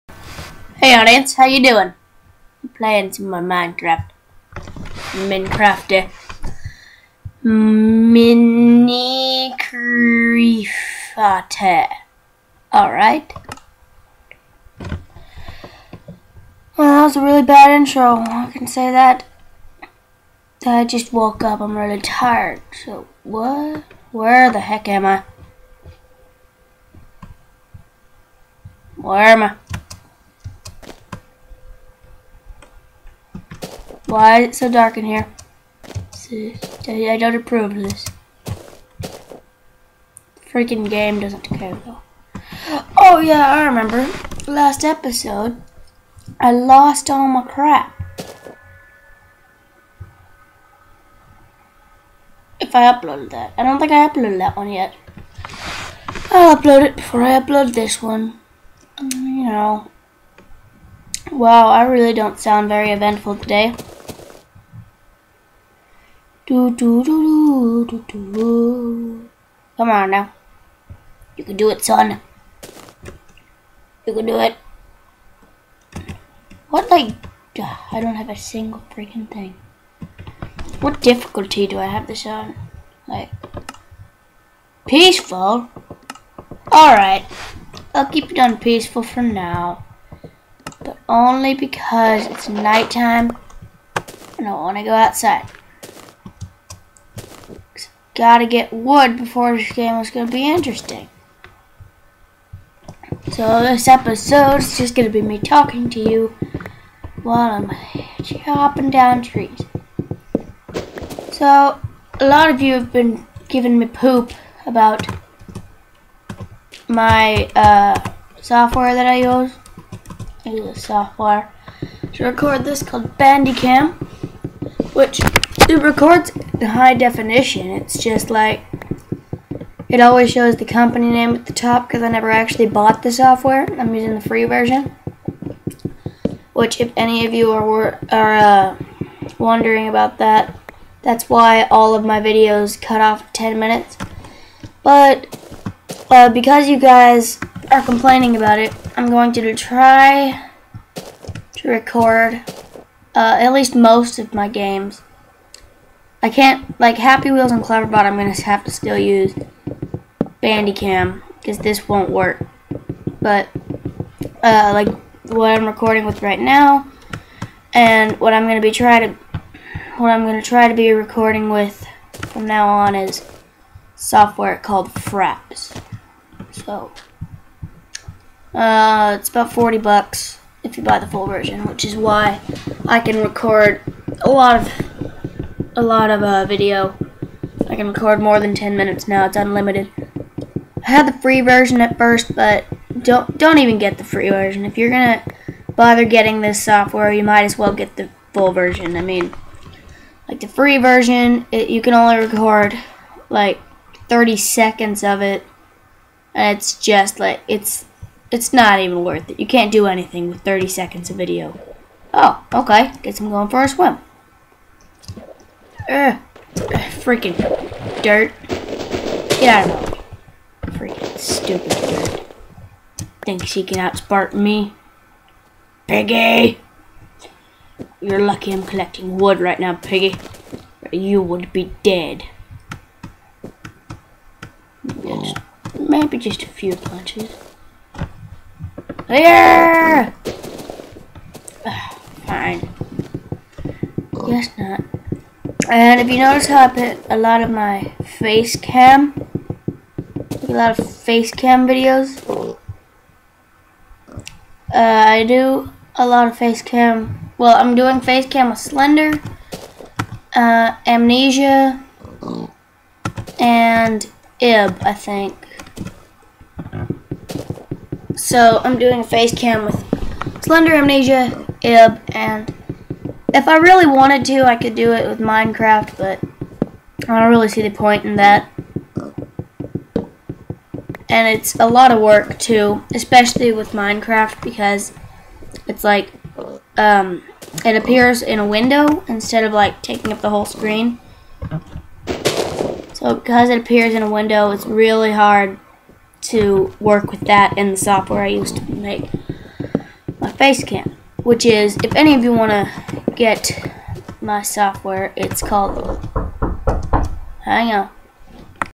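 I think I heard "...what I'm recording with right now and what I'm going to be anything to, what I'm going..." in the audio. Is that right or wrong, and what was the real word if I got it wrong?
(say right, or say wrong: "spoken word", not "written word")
wrong: "trying", not "anything".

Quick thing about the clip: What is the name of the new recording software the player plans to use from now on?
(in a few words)
Fraps.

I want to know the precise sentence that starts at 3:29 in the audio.
You can't do anything with 30 seconds of video.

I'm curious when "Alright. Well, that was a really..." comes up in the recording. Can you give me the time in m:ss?
0:12.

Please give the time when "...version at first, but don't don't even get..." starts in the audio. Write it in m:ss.
3:11.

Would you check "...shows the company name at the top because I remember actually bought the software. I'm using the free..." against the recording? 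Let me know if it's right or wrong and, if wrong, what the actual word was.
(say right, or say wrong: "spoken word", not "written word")
wrong: "never", not "remember".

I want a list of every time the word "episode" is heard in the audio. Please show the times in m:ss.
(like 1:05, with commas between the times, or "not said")
0:44, 1:43.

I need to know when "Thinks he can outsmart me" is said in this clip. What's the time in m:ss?
3:43.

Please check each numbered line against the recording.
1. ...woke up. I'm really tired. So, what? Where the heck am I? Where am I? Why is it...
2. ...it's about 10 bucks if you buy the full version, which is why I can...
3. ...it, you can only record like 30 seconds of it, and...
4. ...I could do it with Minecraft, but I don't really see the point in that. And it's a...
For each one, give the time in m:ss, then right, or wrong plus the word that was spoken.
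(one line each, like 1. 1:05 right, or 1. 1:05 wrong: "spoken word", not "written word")
1. 0:21 right
2. 2:59 wrong: "40", not "10"
3. 3:21 right
4. 4:34 right.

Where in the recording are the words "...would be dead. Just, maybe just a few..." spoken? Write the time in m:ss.
3:51.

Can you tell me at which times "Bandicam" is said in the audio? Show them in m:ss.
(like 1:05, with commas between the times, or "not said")
2:03, 2:40.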